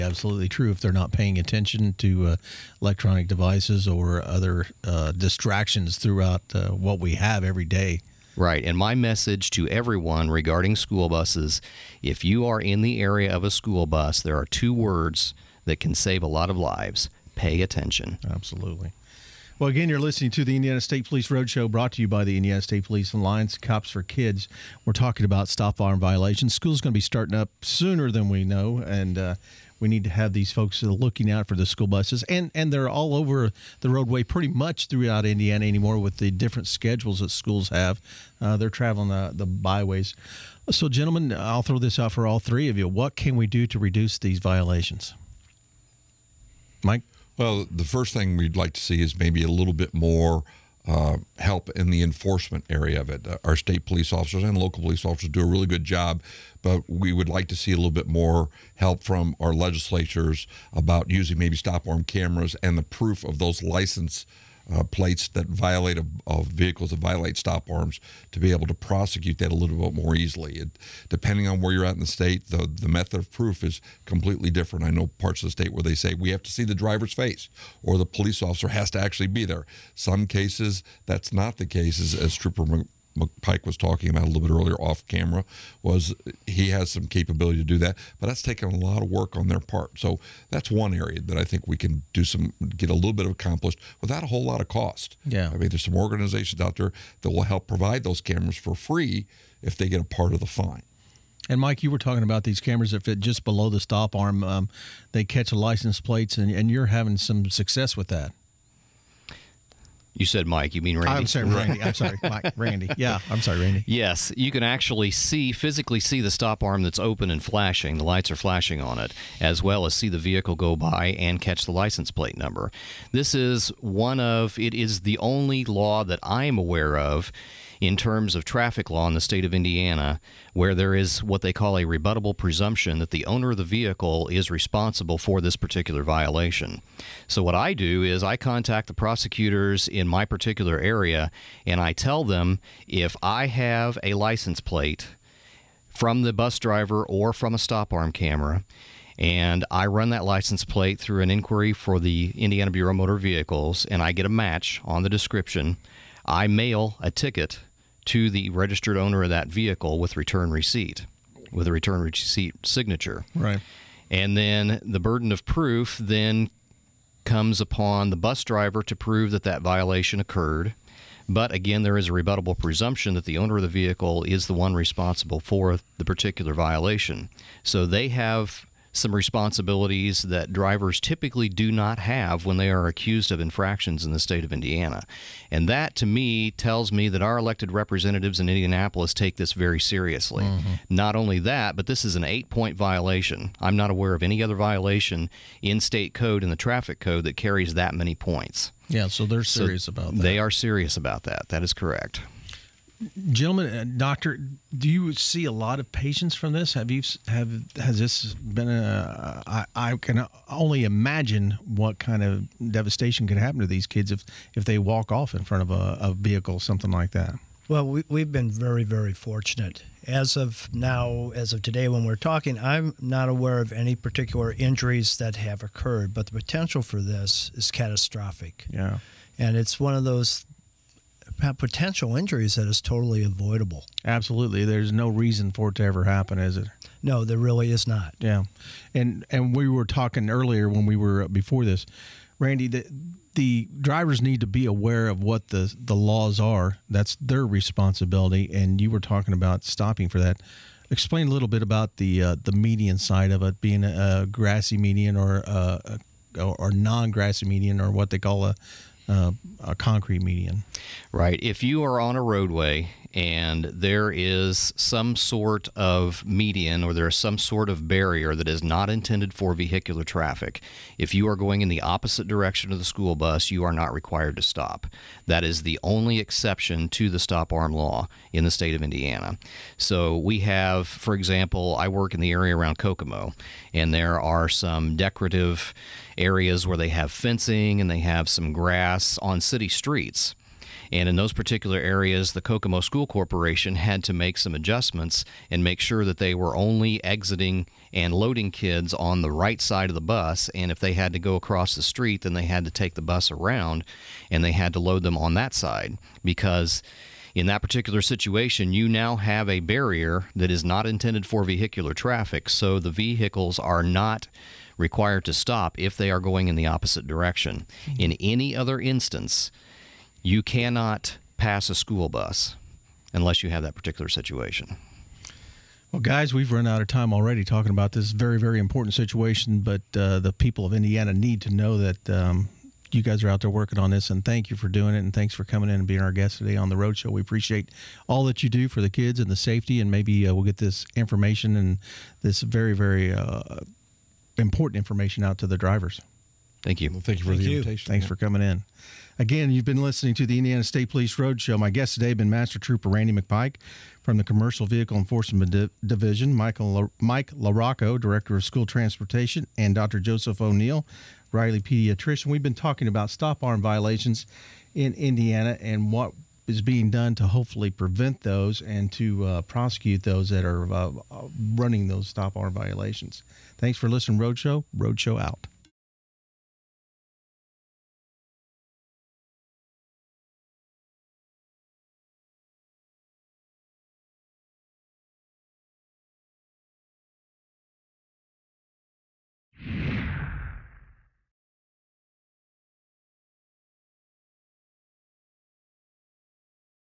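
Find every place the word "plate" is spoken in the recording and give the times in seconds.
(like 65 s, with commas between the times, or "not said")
64 s, 106 s, 122 s, 144 s, 150 s.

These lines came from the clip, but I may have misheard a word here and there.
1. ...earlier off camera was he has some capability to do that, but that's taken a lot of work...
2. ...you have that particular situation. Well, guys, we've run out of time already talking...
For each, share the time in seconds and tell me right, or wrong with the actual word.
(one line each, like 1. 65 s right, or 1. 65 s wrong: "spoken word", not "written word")
1. 84 s right
2. 323 s right.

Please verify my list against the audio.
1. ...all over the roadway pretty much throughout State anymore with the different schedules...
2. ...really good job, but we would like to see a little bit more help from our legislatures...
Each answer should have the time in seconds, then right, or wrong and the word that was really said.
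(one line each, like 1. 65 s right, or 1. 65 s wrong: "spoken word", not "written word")
1. 32 s wrong: "Indiana", not "State"
2. 55 s right.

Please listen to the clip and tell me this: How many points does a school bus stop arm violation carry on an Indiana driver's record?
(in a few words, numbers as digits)
8.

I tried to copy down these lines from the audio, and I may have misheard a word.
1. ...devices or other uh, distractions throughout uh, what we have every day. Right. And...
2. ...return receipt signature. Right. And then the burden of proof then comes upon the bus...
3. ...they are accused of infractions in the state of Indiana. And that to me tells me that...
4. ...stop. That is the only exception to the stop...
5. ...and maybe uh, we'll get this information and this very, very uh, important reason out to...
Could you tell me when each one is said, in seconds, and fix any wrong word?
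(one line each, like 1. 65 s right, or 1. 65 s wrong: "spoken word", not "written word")
1. 3 s right
2. 161 s right
3. 182 s right
4. 274 s right
5. 339 s wrong: "information", not "reason".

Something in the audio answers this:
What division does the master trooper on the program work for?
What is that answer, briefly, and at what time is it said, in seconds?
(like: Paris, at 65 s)
Commercial Vehicle Enforcement Division, at 354 s.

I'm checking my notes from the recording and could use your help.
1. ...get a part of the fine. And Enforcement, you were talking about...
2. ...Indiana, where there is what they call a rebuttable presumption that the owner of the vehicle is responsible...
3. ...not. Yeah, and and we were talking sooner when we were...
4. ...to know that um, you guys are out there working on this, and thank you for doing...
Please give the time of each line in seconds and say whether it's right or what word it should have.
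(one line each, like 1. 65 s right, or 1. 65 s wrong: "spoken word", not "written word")
1. 99 s wrong: "Mike", not "Enforcement"
2. 129 s right
3. 237 s wrong: "earlier", not "sooner"
4. 331 s right.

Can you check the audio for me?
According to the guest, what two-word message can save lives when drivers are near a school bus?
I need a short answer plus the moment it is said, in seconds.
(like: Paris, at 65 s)
Pay attention, at 17 s.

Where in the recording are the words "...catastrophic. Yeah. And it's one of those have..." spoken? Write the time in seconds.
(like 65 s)
227 s.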